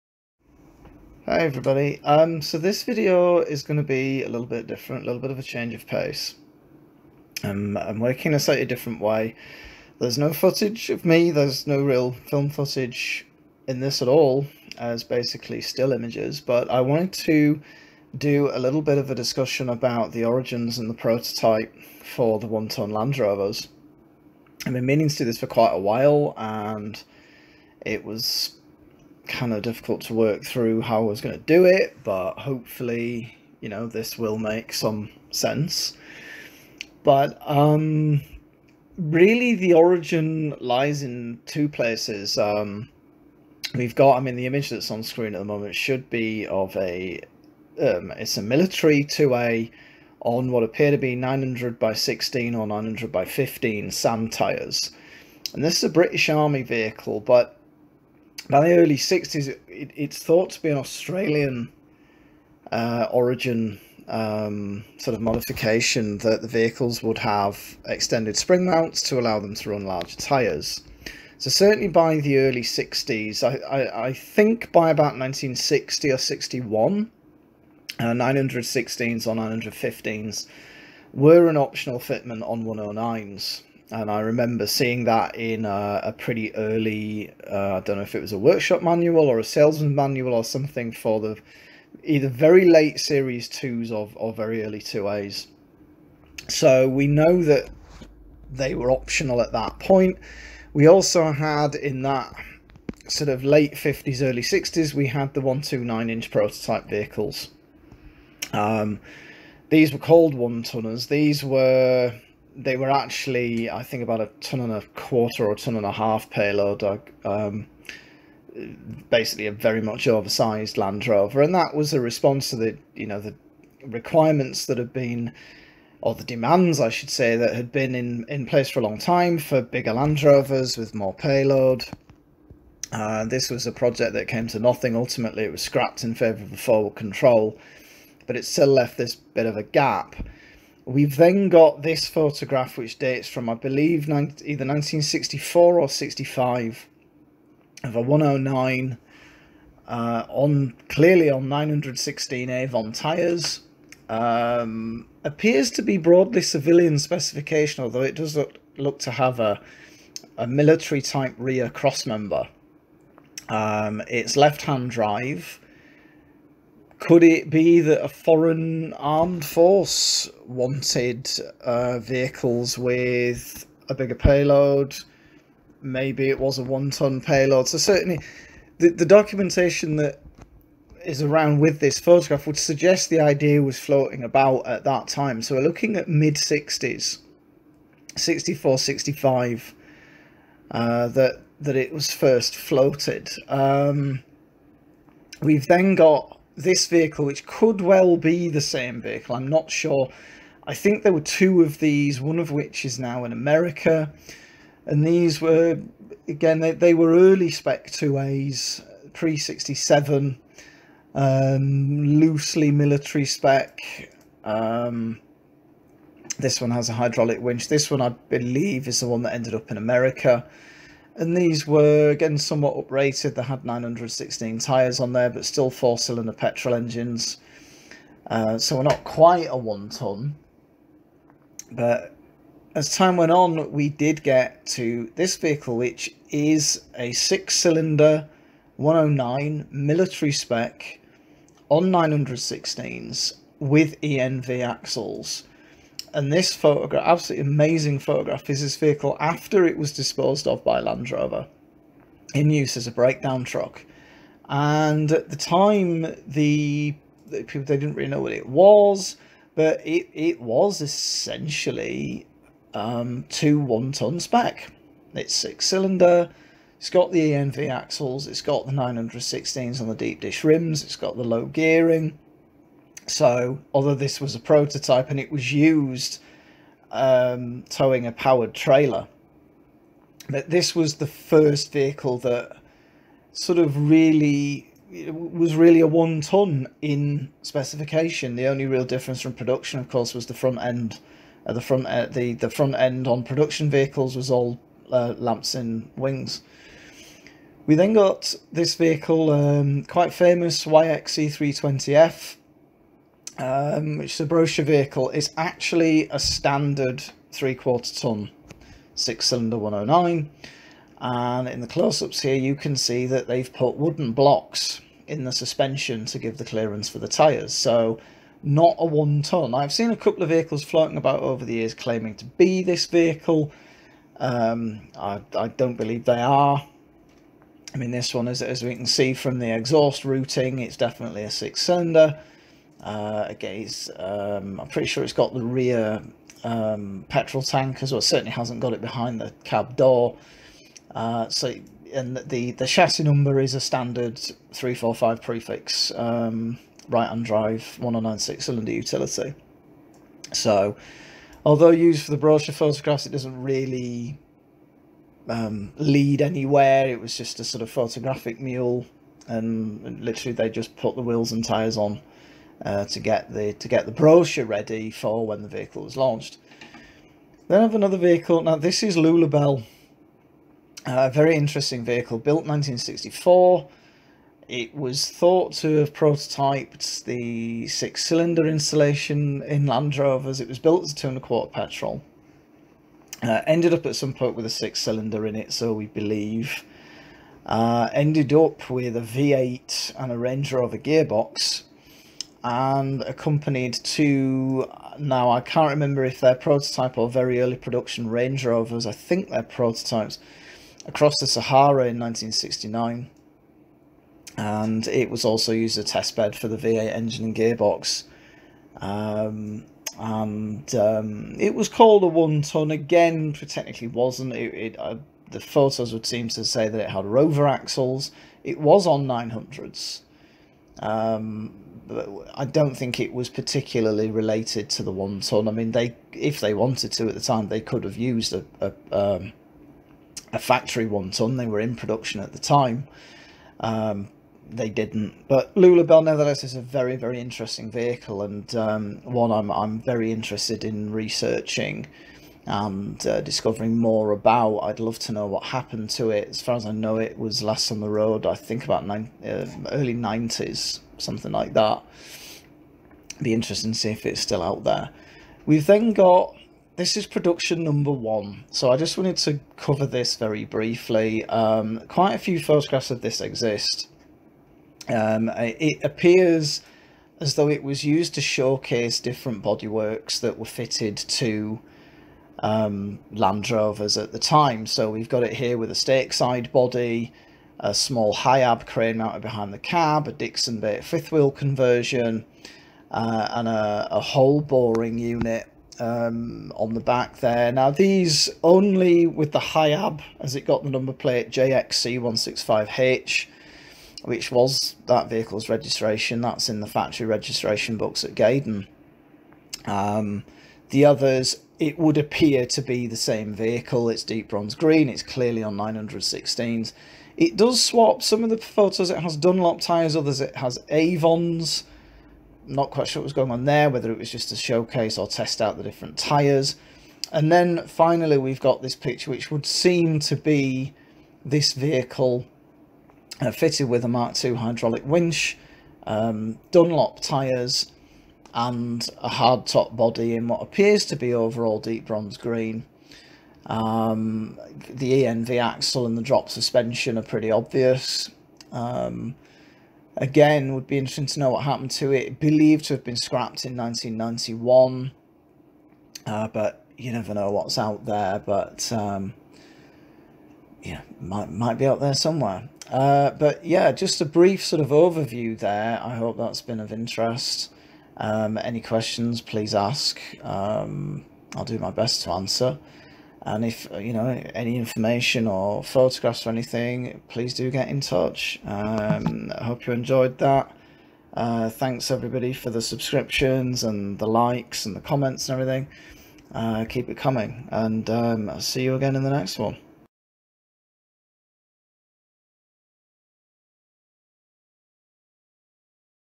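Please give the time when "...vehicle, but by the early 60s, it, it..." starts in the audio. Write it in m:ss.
0:56.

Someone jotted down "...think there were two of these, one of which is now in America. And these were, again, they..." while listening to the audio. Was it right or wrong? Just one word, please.
right.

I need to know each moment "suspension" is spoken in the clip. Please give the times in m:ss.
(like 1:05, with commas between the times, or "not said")
5:15, 8:56.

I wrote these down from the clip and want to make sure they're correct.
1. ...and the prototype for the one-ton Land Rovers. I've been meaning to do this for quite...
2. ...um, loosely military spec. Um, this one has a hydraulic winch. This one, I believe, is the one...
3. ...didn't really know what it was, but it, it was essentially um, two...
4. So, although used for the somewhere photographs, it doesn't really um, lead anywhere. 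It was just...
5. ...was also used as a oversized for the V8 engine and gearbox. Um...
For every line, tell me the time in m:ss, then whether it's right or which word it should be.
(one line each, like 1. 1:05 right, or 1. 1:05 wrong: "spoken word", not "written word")
1. 0:20 right
2. 3:31 right
3. 4:17 right
4. 5:50 wrong: "brochure", not "somewhere"
5. 6:45 wrong: "testbed", not "oversized".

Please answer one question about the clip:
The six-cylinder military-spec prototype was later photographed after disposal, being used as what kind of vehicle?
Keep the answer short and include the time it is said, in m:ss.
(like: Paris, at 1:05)
breakdown truck, at 4:12.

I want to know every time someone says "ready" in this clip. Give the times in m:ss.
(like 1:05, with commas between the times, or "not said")
6:04.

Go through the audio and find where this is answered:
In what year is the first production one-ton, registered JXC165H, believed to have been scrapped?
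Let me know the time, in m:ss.
9:03.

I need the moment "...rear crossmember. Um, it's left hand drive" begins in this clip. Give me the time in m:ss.
2:41.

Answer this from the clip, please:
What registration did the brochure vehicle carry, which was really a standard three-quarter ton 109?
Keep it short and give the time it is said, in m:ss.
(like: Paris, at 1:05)
YXC320F, at 5:00.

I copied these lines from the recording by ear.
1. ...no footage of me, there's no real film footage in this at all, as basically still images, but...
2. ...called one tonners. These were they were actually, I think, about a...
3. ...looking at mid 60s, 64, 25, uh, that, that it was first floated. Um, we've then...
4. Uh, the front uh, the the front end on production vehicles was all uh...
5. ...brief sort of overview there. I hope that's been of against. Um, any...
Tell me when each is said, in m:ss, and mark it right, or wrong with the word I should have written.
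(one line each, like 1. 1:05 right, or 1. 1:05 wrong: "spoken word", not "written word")
1. 0:10 right
2. 1:49 right
3. 3:05 wrong: "65", not "25"
4. 4:51 right
5. 9:14 wrong: "interest", not "against".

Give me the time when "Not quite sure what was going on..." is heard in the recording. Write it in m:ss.
8:32.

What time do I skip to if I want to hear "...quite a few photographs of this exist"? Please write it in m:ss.
7:41.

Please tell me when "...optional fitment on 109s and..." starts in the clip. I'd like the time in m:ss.
1:21.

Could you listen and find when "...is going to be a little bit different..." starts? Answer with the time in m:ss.
0:03.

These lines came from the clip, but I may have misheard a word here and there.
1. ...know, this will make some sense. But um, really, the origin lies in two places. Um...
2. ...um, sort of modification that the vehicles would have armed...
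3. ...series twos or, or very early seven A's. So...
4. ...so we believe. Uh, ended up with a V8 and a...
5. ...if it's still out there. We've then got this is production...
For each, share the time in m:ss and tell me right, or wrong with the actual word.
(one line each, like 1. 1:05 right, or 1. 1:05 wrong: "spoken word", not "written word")
1. 0:33 right
2. 1:04 wrong: "extended", not "armed"
3. 1:33 wrong: "two", not "seven"
4. 6:25 right
5. 7:33 right.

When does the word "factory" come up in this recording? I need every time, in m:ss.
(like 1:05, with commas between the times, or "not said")
7:10, 8:16.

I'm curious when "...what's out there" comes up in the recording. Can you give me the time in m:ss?
9:07.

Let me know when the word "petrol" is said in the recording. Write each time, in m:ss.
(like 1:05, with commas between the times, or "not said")
3:46, 5:37, 6:21.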